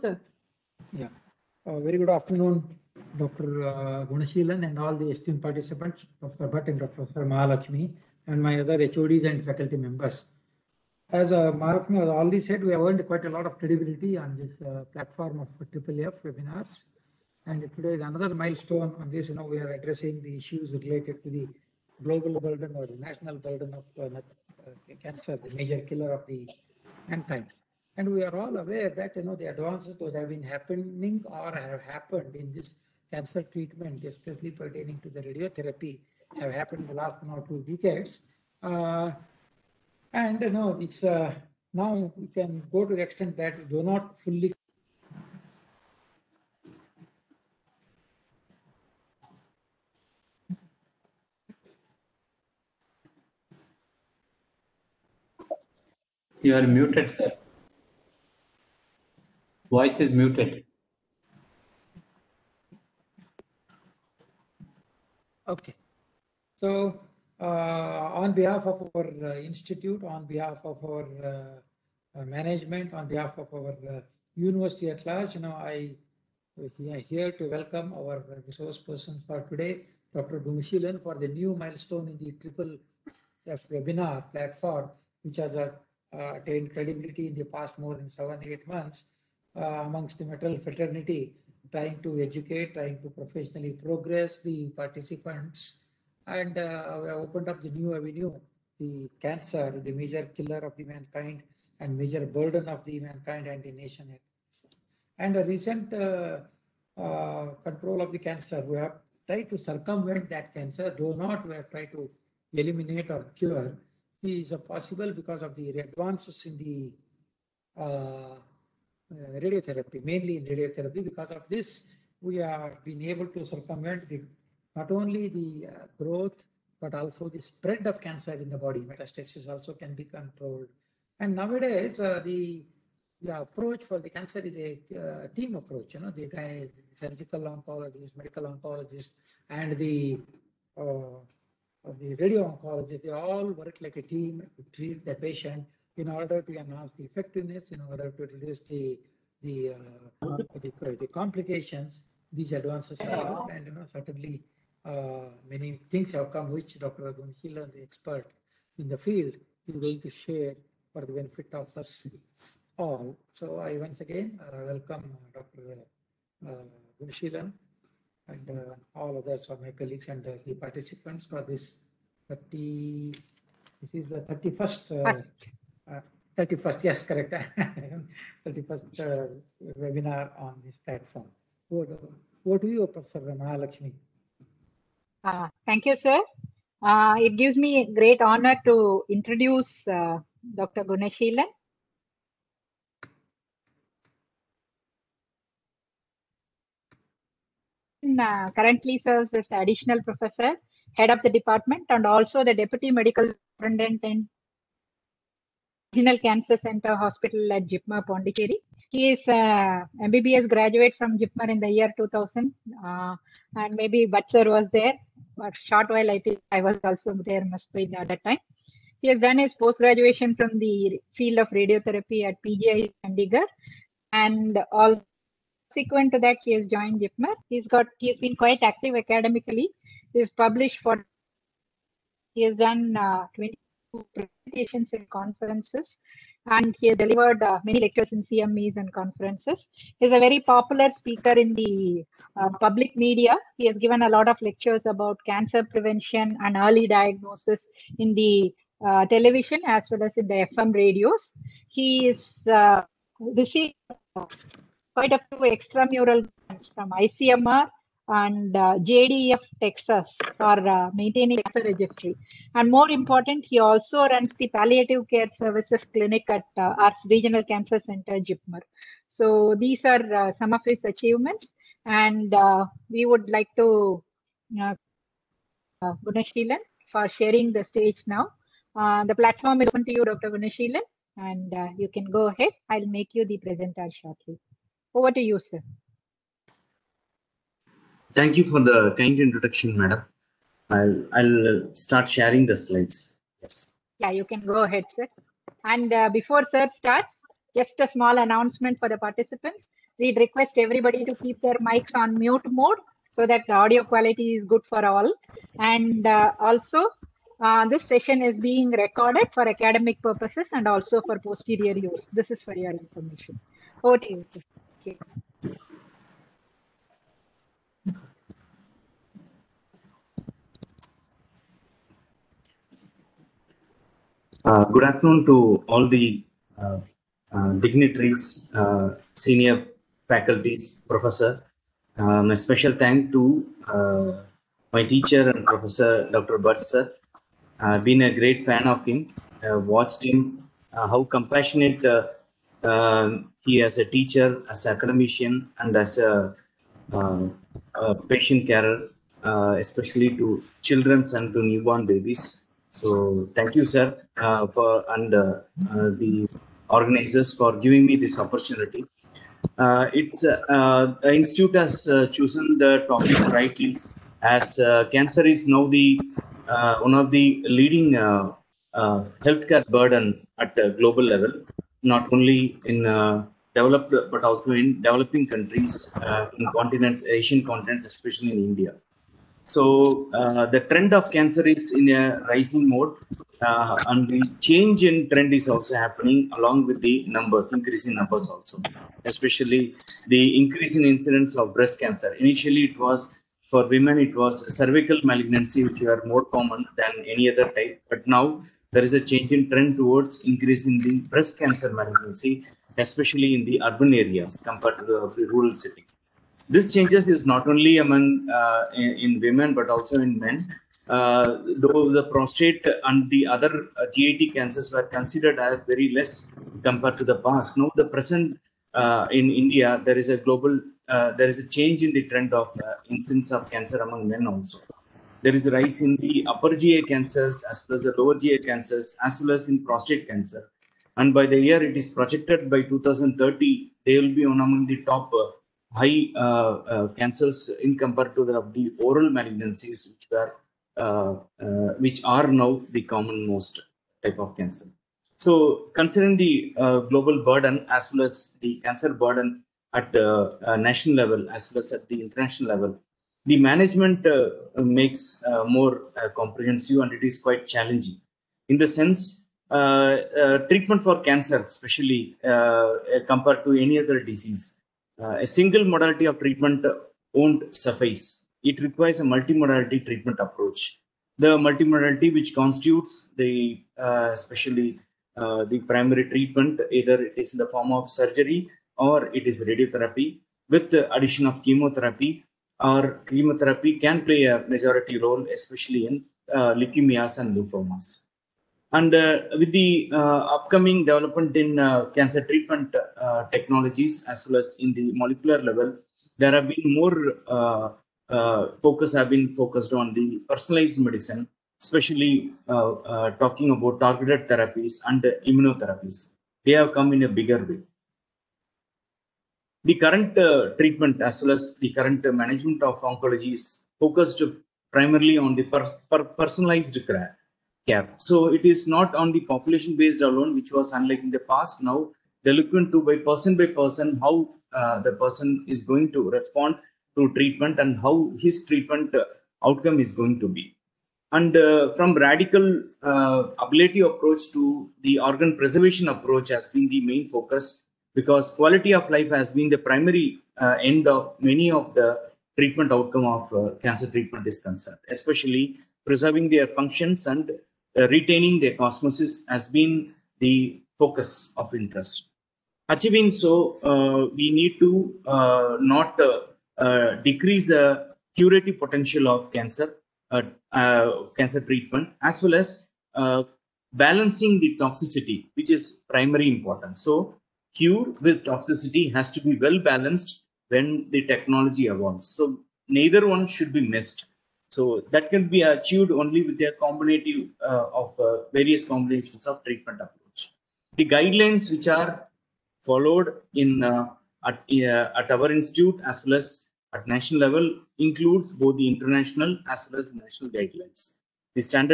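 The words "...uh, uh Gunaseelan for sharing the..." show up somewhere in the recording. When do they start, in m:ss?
4:34.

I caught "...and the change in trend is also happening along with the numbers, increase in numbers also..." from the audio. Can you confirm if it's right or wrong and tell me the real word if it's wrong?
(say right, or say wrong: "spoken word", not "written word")
right.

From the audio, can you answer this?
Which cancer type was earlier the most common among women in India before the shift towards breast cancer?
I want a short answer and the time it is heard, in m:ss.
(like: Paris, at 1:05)
cervical malignancy, at 6:34.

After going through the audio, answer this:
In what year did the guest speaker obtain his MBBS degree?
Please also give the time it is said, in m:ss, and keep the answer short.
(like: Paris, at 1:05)
2000, at 3:31.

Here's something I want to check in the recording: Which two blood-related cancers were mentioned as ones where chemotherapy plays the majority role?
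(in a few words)
leukemias and lymphomas.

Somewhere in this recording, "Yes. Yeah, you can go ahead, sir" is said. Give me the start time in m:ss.
4:53.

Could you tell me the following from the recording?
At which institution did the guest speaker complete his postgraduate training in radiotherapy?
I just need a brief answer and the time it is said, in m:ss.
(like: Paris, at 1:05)
PGI Chandigarh, at 3:42.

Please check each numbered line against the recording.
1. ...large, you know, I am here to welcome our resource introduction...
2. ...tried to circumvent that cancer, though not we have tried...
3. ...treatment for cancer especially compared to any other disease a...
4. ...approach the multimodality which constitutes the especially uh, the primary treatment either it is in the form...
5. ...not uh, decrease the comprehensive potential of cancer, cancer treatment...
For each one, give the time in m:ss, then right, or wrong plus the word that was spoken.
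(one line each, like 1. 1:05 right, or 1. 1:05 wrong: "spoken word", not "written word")
1. 1:15 wrong: "person", not "introduction"
2. 1:49 right
3. 7:40 right
4. 7:50 right
5. 9:15 wrong: "curative", not "comprehensive".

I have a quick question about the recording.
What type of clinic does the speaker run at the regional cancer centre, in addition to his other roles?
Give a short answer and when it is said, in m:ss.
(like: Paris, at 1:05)
palliative care services clinic, at 4:24.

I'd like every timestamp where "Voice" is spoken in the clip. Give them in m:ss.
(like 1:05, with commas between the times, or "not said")
0:59.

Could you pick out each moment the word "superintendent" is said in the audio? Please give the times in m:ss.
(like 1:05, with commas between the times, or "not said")
3:23.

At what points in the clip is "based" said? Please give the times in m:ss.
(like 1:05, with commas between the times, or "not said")
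8:39.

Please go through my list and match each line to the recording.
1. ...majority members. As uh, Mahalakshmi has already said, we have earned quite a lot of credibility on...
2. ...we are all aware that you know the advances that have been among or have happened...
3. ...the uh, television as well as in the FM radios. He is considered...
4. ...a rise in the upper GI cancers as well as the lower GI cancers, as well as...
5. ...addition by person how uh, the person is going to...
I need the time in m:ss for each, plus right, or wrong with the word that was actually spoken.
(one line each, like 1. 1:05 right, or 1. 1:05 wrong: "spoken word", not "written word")
1. 0:09 wrong: "faculty", not "majority"
2. 0:28 wrong: "happening", not "among"
3. 4:08 wrong: "received", not "considered"
4. 7:05 right
5. 8:43 wrong: "person", not "addition".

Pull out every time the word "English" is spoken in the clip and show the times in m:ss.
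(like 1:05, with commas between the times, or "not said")
not said.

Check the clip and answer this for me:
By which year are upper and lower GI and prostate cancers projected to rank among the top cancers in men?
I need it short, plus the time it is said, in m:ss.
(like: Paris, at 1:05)
2030, at 7:12.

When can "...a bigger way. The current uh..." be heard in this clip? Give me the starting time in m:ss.
8:27.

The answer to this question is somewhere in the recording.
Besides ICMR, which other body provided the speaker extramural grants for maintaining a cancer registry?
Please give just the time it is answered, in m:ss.
4:18.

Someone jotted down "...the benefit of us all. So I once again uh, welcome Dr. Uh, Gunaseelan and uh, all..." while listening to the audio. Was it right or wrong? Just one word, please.
right.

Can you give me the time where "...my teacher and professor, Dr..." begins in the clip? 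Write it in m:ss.
5:34.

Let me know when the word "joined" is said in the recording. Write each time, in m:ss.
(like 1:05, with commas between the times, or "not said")
3:46.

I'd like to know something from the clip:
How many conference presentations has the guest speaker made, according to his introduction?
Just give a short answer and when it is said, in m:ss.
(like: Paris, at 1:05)
22, at 3:53.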